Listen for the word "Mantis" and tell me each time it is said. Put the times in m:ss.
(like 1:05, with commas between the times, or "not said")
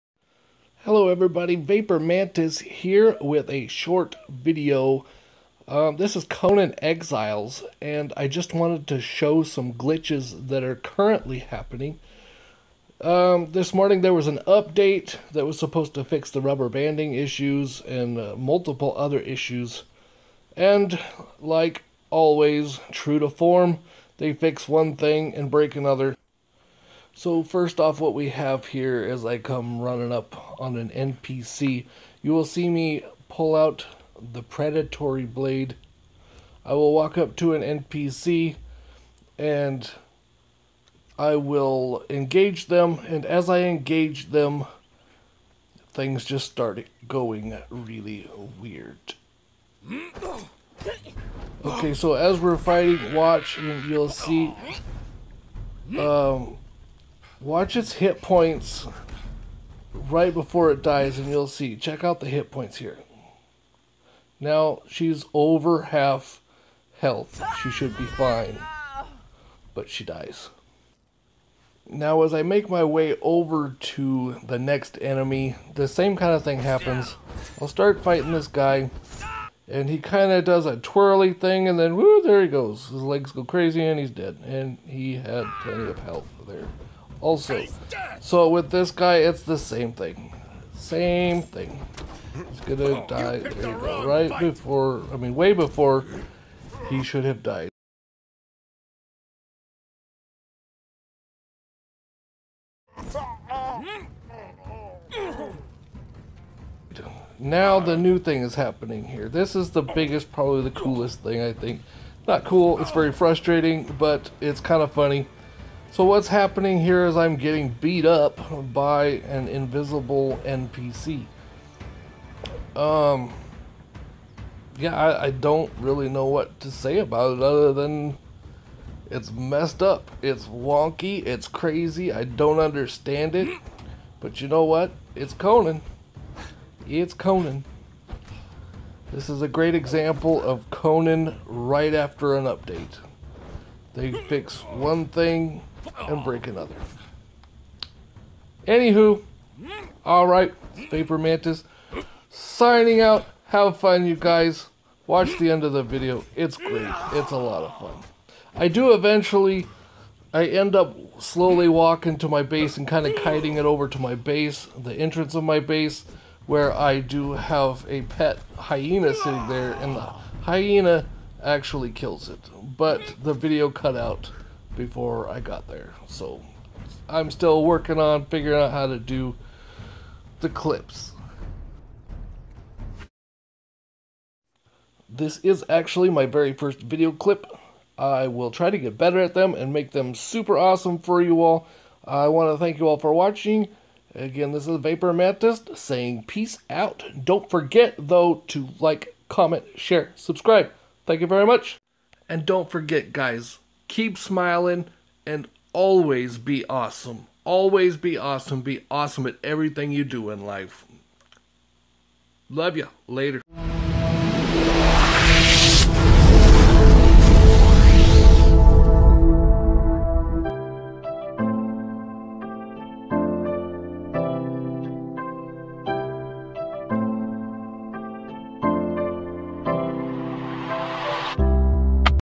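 0:01, 2:31, 3:15.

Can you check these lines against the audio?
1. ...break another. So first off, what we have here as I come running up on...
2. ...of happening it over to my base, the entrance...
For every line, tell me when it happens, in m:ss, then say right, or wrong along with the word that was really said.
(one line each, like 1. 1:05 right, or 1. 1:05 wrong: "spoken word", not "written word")
1. 0:25 right
2. 2:43 wrong: "kiting", not "happening".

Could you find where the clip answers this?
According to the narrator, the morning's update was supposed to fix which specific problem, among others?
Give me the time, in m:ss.
0:16.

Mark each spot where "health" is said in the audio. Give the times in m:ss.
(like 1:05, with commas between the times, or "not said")
1:06, 1:25.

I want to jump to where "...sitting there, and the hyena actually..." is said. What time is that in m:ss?
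2:49.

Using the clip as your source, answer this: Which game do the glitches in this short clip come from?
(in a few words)
Conan Exiles.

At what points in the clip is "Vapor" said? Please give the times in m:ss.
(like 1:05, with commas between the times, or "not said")
0:01, 2:30, 3:14.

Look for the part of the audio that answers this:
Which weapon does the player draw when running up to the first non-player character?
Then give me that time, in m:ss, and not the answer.
0:34.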